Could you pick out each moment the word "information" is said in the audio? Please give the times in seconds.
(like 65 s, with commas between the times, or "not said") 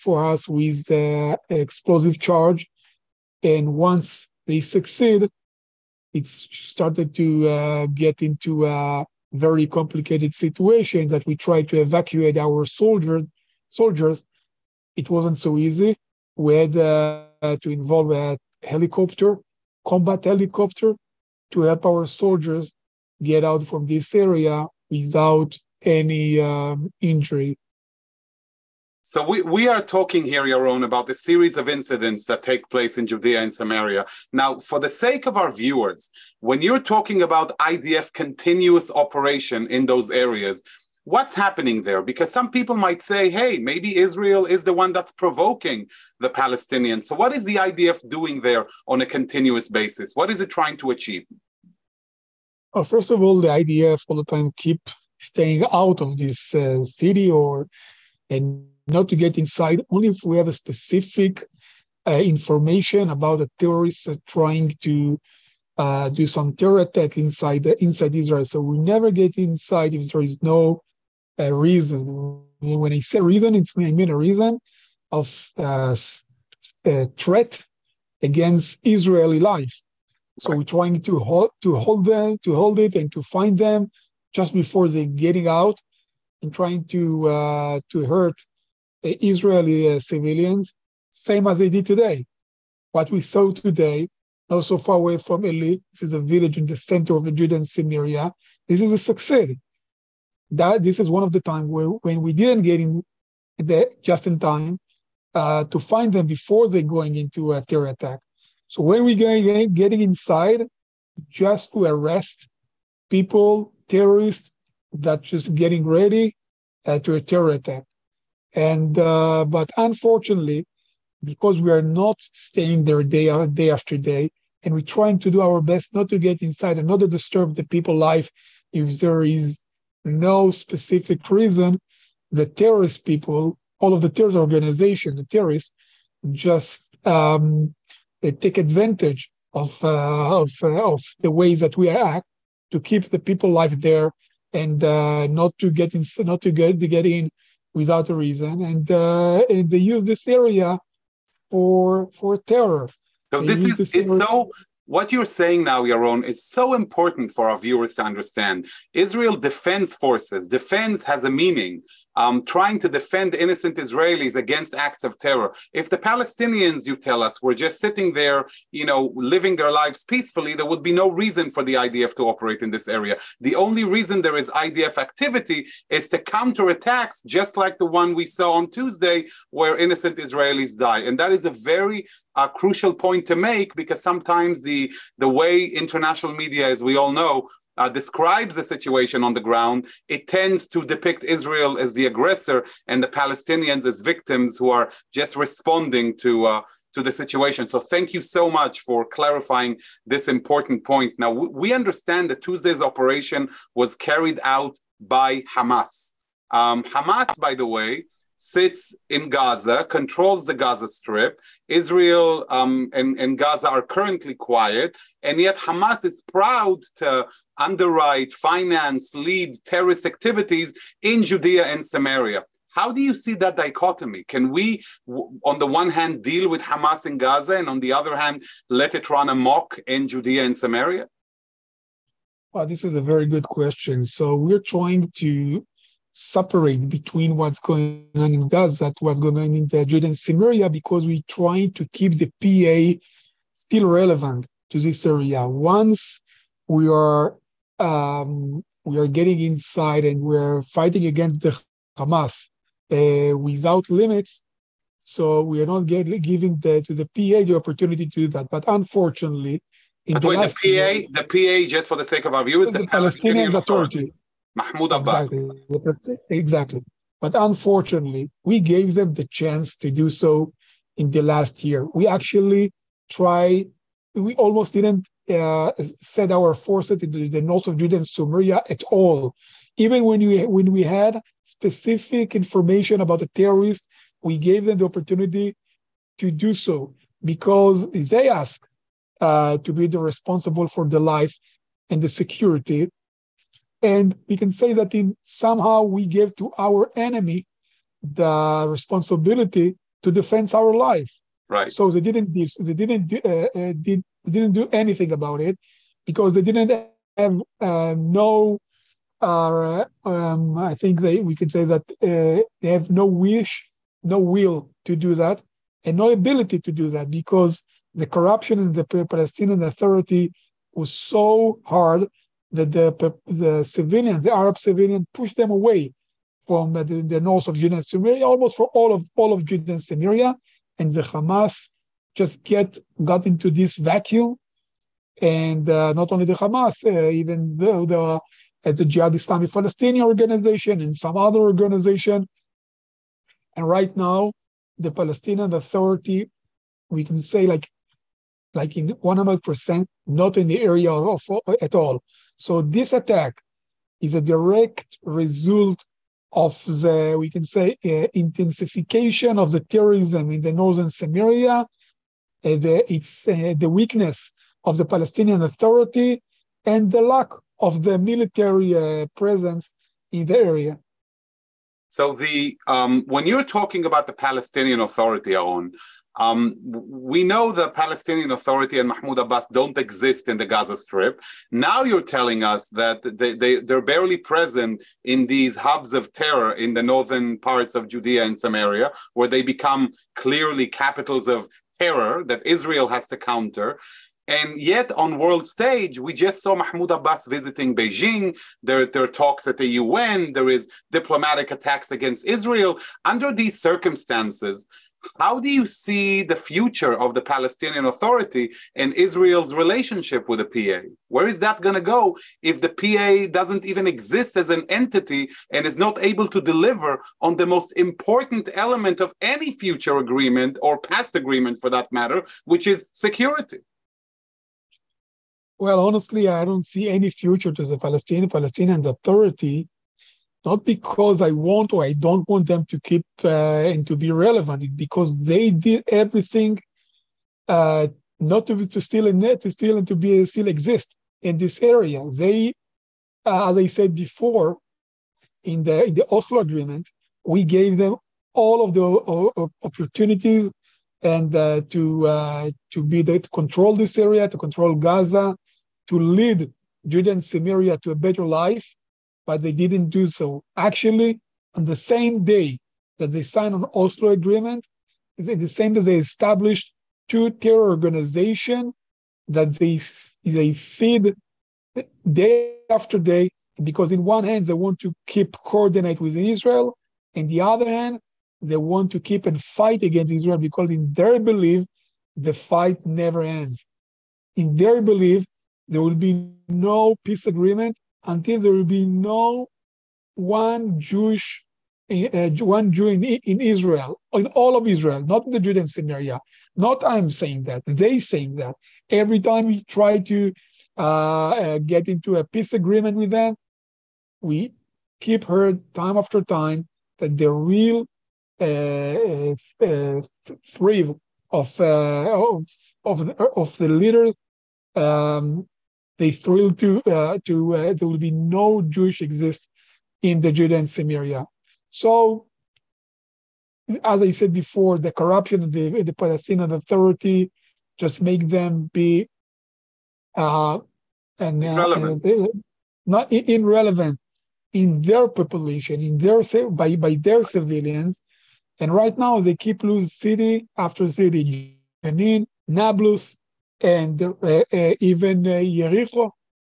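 62 s, 282 s.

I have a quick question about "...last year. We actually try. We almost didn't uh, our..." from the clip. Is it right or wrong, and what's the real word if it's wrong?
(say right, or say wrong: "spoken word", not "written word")
right.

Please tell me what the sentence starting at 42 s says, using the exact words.
Because some people might say, hey, maybe Israel is the one that's provoking the Palestinians.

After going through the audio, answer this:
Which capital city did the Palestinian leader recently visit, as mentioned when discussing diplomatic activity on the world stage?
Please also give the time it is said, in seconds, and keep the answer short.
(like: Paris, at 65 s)
Beijing, at 397 s.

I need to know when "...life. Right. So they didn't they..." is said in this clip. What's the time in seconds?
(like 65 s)
300 s.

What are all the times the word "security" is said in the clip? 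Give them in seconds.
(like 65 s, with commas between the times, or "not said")
292 s, 422 s.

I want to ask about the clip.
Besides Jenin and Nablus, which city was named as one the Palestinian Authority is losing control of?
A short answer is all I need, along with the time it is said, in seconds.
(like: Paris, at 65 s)
Jericho, at 545 s.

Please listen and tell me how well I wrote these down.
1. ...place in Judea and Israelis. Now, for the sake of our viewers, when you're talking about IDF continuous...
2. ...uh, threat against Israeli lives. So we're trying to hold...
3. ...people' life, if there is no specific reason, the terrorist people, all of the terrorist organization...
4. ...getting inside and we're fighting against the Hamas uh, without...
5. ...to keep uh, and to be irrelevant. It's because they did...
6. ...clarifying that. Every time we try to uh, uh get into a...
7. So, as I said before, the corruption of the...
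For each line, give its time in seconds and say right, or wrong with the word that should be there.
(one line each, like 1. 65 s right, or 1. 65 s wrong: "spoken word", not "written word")
1. 32 s wrong: "Samaria", not "Israelis"
2. 76 s right
3. 127 s right
4. 249 s right
5. 432 s wrong: "relevant", not "irrelevant"
6. 497 s wrong: "saying", not "clarifying"
7. 521 s right.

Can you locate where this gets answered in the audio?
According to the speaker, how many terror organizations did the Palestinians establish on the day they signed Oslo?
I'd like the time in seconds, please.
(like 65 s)
467 s.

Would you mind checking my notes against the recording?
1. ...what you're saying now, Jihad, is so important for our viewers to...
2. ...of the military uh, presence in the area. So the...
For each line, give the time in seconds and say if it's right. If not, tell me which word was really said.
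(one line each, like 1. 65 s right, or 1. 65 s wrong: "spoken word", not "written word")
1. 154 s wrong: "Yaron", not "Jihad"
2. 367 s right.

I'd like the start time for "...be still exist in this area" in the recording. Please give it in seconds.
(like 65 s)
439 s.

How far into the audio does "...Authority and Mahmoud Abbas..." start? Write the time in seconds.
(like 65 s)
378 s.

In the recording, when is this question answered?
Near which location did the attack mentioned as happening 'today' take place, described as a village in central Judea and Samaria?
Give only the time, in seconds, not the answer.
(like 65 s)
95 s.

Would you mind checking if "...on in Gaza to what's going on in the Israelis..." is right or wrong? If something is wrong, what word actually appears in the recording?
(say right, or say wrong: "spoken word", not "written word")
wrong: "Judea", not "Israelis".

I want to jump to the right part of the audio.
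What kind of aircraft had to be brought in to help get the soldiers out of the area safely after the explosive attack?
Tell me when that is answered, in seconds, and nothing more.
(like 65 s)
19 s.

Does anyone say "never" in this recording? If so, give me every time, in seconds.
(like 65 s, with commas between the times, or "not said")
68 s, 482 s.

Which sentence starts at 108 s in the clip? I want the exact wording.
So when we're going getting inside, just to arrest people, terrorists that just getting ready uh, to a terror attack.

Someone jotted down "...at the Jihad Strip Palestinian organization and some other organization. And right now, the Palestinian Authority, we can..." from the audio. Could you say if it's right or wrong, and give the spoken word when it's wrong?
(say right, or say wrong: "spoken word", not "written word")
wrong: "Islamic", not "Strip".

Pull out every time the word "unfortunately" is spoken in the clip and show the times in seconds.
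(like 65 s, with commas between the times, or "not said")
119 s, 258 s, 267 s.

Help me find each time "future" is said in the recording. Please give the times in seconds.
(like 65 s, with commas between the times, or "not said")
406 s, 419 s, 427 s.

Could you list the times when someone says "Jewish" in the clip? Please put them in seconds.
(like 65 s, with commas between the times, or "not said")
490 s, 518 s.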